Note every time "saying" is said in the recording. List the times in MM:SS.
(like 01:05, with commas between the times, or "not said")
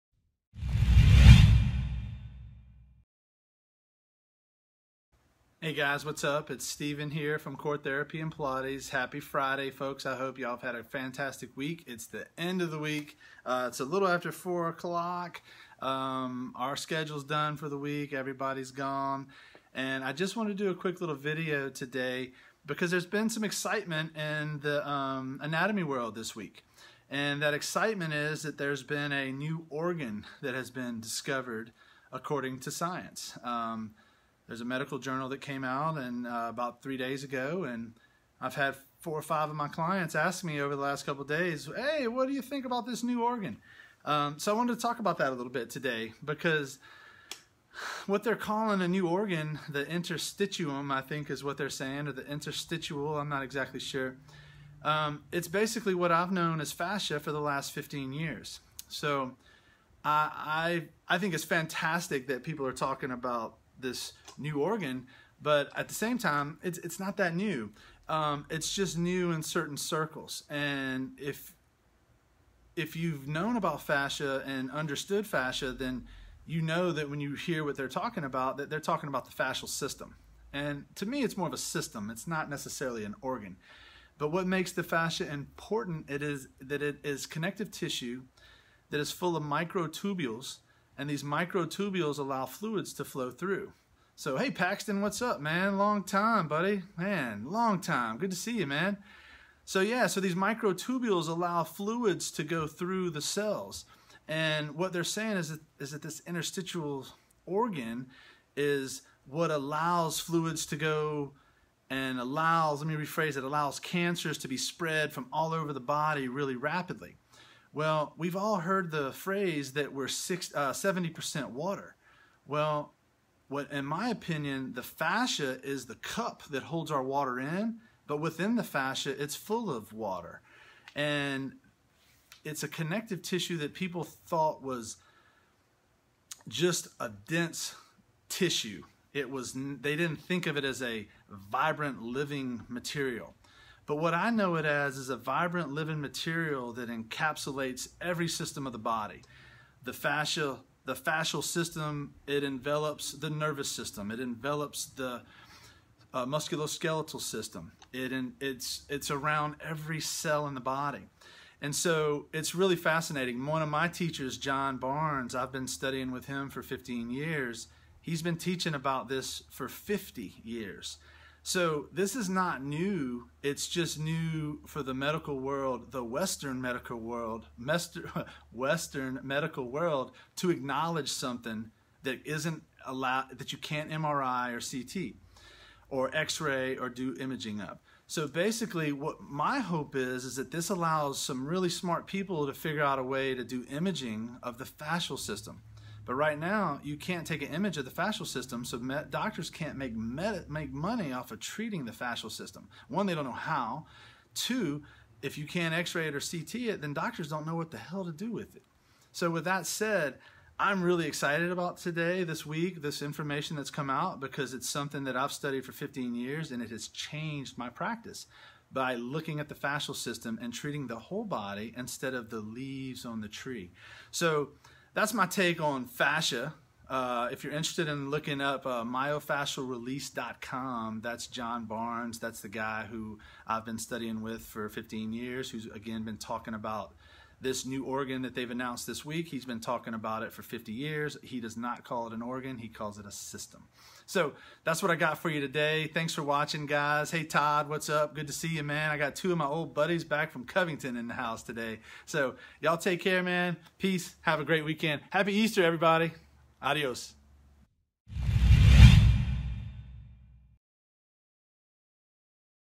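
00:51, 01:45.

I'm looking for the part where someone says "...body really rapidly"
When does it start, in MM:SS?
01:55.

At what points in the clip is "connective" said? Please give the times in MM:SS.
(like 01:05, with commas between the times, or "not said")
01:27, 02:12.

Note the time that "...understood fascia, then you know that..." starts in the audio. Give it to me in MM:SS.
01:14.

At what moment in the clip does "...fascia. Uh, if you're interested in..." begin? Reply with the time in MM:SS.
03:45.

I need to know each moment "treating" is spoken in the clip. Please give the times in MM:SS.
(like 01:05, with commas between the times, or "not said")
03:21, 03:40.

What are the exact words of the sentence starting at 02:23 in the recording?
But what I know it as is a vibrant living material that encapsulates every system of the body.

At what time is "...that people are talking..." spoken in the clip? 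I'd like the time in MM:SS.
01:02.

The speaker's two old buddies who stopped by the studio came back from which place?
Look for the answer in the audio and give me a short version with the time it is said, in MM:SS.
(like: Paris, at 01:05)
Covington, at 04:10.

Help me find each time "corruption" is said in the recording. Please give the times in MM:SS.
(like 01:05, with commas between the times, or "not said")
not said.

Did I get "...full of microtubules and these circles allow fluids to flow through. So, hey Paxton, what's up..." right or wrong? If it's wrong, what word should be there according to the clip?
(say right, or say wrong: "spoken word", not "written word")
wrong: "microtubules", not "circles".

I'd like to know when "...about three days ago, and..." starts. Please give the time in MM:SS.
00:36.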